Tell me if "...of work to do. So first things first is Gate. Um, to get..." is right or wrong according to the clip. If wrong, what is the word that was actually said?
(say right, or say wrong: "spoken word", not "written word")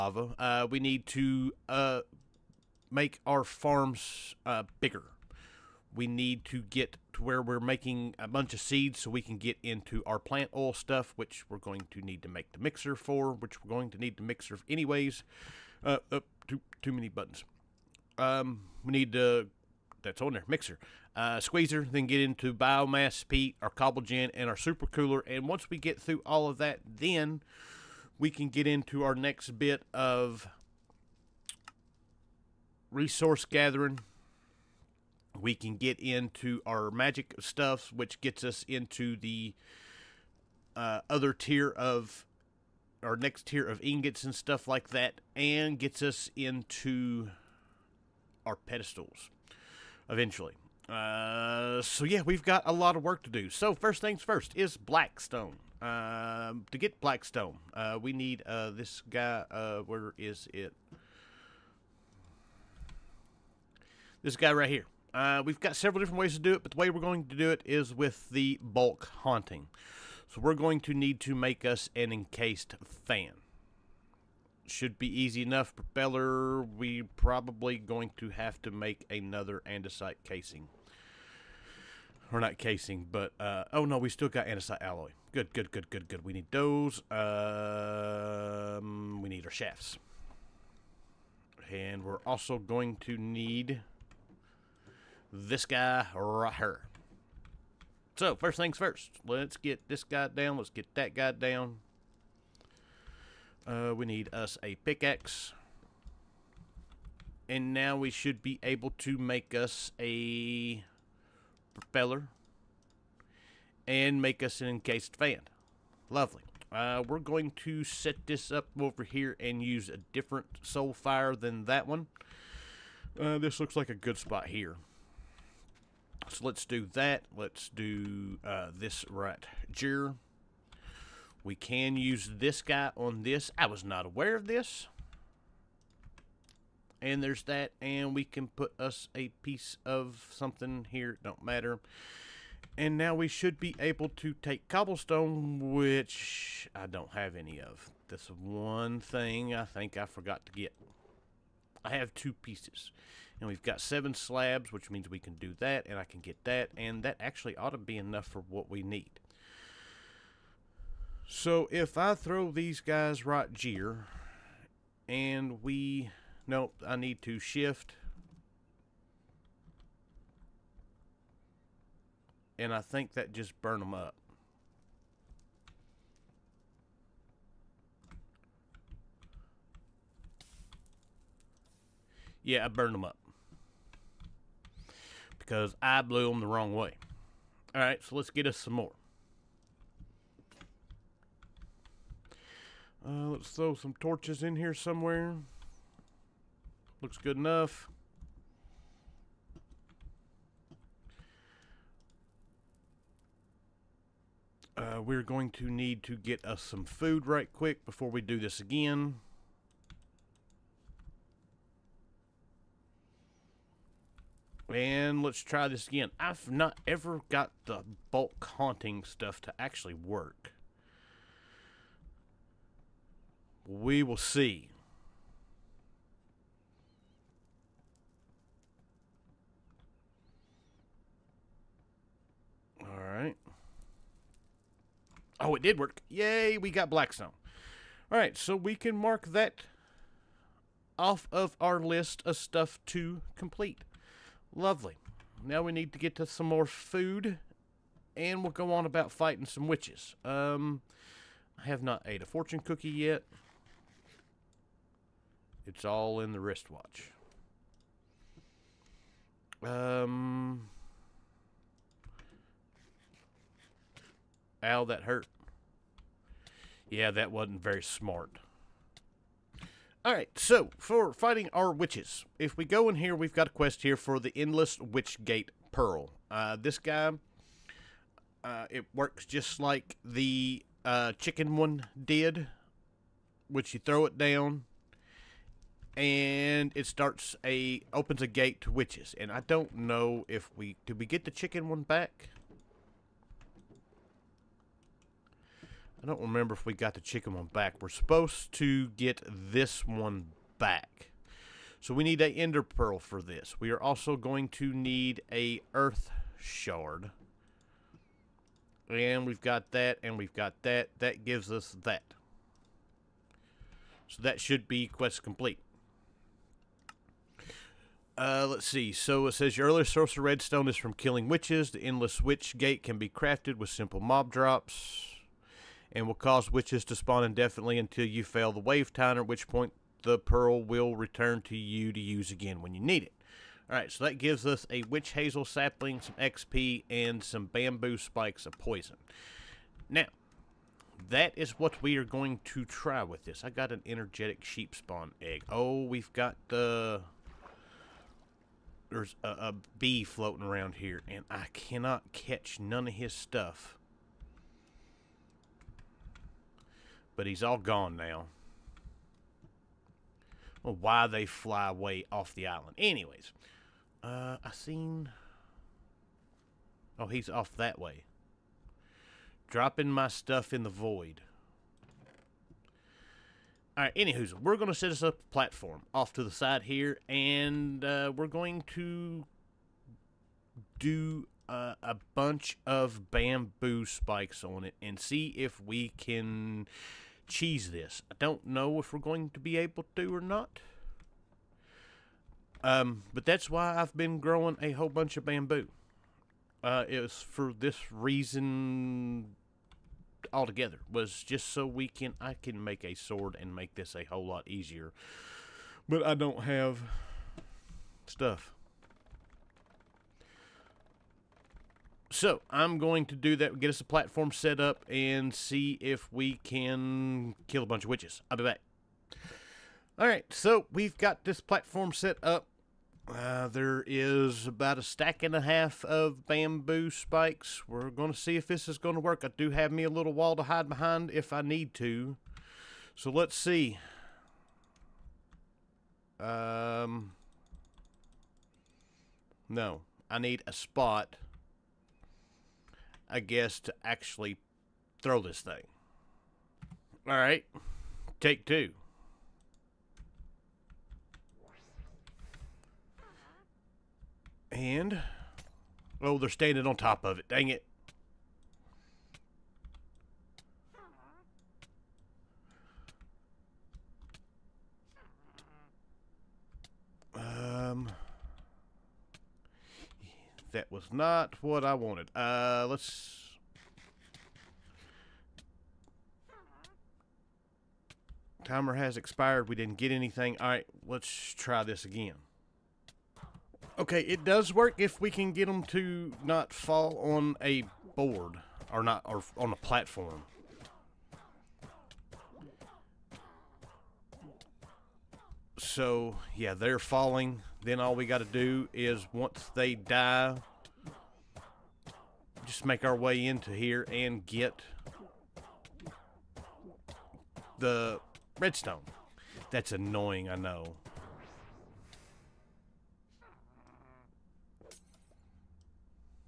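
wrong: "Blackstone", not "Gate".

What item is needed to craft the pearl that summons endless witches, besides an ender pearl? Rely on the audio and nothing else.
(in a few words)
earth shard.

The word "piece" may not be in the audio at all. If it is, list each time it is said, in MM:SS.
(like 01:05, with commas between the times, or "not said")
02:19, 02:32.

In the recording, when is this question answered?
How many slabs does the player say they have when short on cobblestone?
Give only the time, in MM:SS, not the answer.
02:33.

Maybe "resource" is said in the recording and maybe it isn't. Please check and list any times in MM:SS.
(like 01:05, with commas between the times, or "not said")
00:32.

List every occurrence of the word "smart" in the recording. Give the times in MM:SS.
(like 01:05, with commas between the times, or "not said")
04:27.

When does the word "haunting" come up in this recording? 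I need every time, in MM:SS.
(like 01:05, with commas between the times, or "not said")
01:09, 03:38.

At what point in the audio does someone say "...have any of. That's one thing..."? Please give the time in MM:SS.
02:27.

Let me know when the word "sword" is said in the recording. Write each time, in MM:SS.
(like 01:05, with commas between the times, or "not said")
06:42.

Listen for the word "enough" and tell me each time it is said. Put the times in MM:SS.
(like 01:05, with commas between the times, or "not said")
01:15, 02:37, 03:17.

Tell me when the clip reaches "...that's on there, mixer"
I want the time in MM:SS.
00:20.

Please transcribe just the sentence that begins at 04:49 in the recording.
And I don't know if we did we get the chicken one back.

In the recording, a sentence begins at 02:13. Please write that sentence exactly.
I was not aware of this.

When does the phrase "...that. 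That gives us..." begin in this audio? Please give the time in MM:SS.
05:10.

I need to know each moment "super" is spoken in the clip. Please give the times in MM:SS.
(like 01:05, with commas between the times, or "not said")
00:24.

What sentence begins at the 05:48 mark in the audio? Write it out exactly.
There's a, a bee floating around here, and I cannot catch none of his stuff.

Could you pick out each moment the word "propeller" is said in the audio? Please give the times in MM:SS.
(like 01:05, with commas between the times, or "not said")
01:15, 01:51.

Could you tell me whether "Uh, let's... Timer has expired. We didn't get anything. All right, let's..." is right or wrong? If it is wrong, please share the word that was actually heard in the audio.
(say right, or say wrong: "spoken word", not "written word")
right.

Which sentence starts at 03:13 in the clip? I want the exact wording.
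Uh, let's throw some torches in here somewhere.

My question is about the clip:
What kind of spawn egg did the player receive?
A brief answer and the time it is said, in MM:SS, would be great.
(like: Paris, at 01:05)
energetic sheep, at 05:43.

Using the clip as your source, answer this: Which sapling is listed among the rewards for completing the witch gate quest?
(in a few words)
witch hazel.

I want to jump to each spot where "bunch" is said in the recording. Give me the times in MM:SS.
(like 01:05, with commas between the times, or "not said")
00:08, 06:22, 06:34, 06:57.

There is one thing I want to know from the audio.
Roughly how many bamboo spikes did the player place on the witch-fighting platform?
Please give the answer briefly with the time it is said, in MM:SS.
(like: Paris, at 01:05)
a stack and a half, at 07:04.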